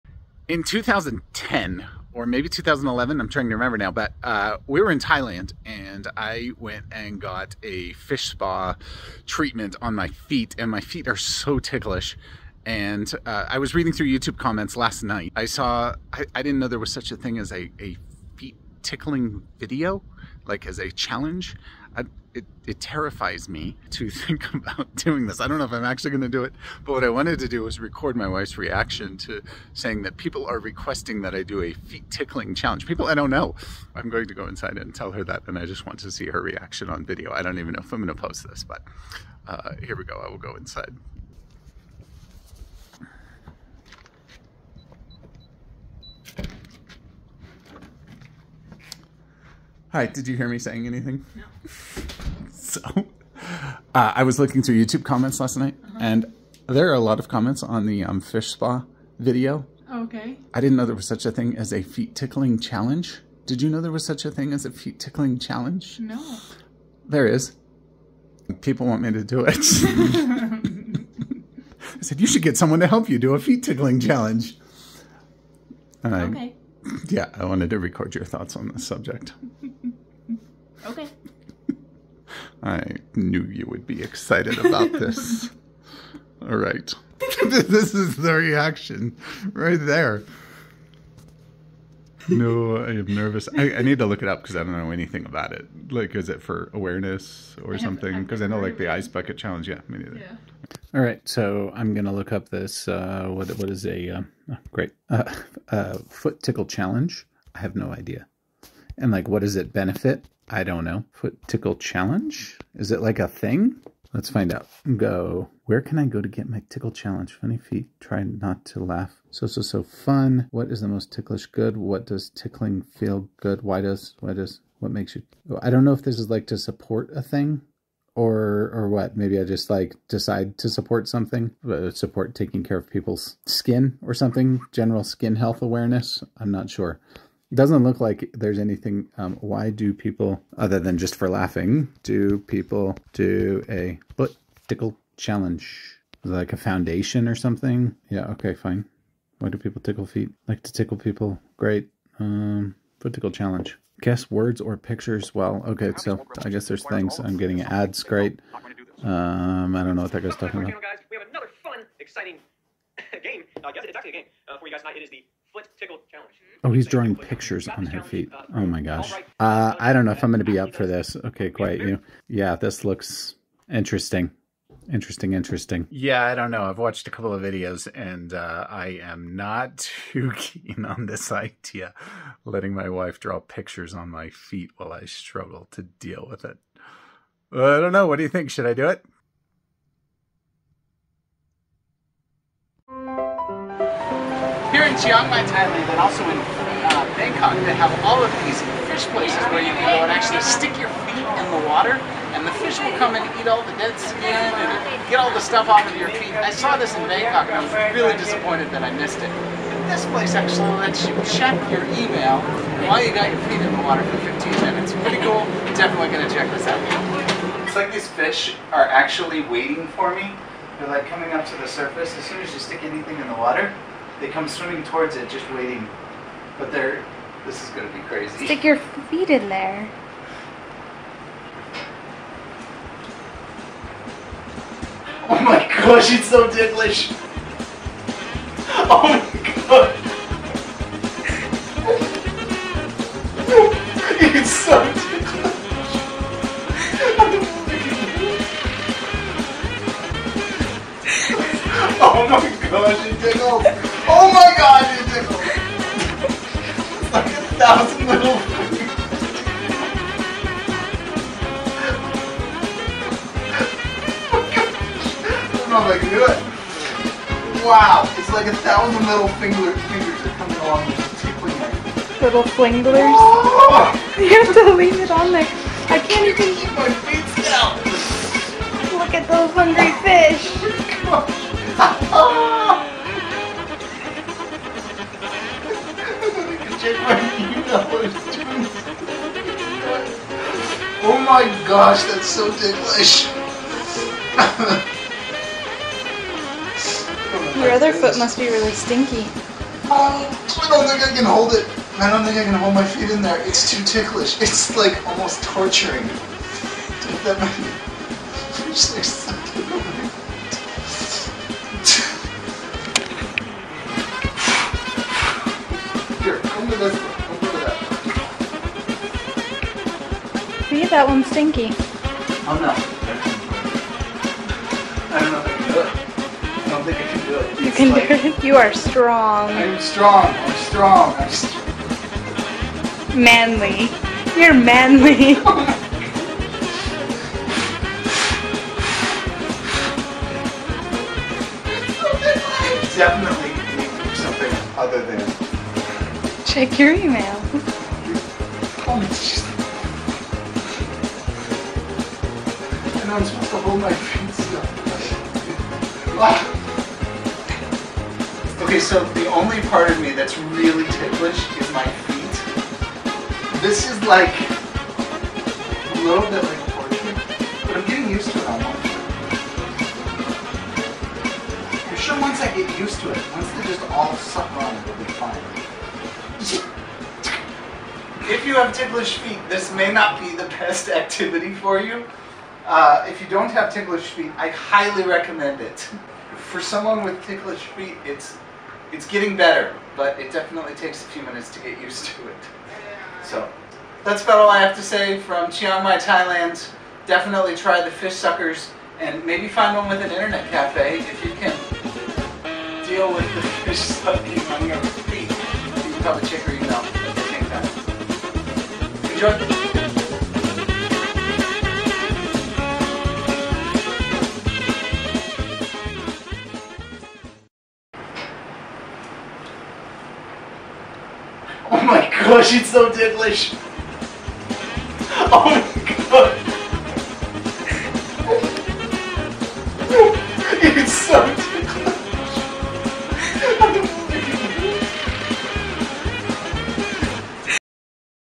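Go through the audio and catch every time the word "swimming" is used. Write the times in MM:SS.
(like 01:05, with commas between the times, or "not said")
03:44.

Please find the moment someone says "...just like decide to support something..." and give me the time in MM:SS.
02:09.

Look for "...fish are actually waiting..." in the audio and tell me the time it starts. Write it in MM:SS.
03:38.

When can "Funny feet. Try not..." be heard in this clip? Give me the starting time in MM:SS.
01:57.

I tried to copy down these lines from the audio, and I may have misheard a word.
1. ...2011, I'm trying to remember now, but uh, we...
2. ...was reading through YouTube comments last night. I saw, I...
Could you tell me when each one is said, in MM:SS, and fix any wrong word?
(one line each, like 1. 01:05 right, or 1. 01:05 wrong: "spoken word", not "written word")
1. 00:02 right
2. 00:13 right.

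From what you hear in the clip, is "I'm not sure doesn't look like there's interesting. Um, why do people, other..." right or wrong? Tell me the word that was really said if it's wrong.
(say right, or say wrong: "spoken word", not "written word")
wrong: "anything", not "interesting".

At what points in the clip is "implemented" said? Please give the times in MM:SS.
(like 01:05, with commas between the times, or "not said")
not said.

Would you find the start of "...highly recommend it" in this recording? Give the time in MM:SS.
06:24.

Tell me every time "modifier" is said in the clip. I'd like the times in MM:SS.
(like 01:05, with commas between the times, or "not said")
not said.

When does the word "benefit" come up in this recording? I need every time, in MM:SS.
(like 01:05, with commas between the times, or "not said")
01:49.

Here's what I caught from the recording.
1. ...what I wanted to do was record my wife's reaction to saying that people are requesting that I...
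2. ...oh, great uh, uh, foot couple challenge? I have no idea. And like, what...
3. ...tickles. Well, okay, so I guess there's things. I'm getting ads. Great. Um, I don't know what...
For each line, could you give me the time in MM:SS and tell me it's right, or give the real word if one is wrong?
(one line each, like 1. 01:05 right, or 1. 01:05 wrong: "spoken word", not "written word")
1. 00:26 right
2. 01:44 wrong: "tickle", not "couple"
3. 02:34 wrong: "pictures", not "tickles".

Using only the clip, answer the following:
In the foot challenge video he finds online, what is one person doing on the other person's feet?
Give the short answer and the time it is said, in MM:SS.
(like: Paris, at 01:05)
drawing pictures, at 02:46.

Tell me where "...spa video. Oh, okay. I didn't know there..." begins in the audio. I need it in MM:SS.
00:58.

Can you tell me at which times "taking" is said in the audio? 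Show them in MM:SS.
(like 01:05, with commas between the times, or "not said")
02:12.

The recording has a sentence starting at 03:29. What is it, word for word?
this place actually lets you check your email while you got your feet in the water for 15 minutes.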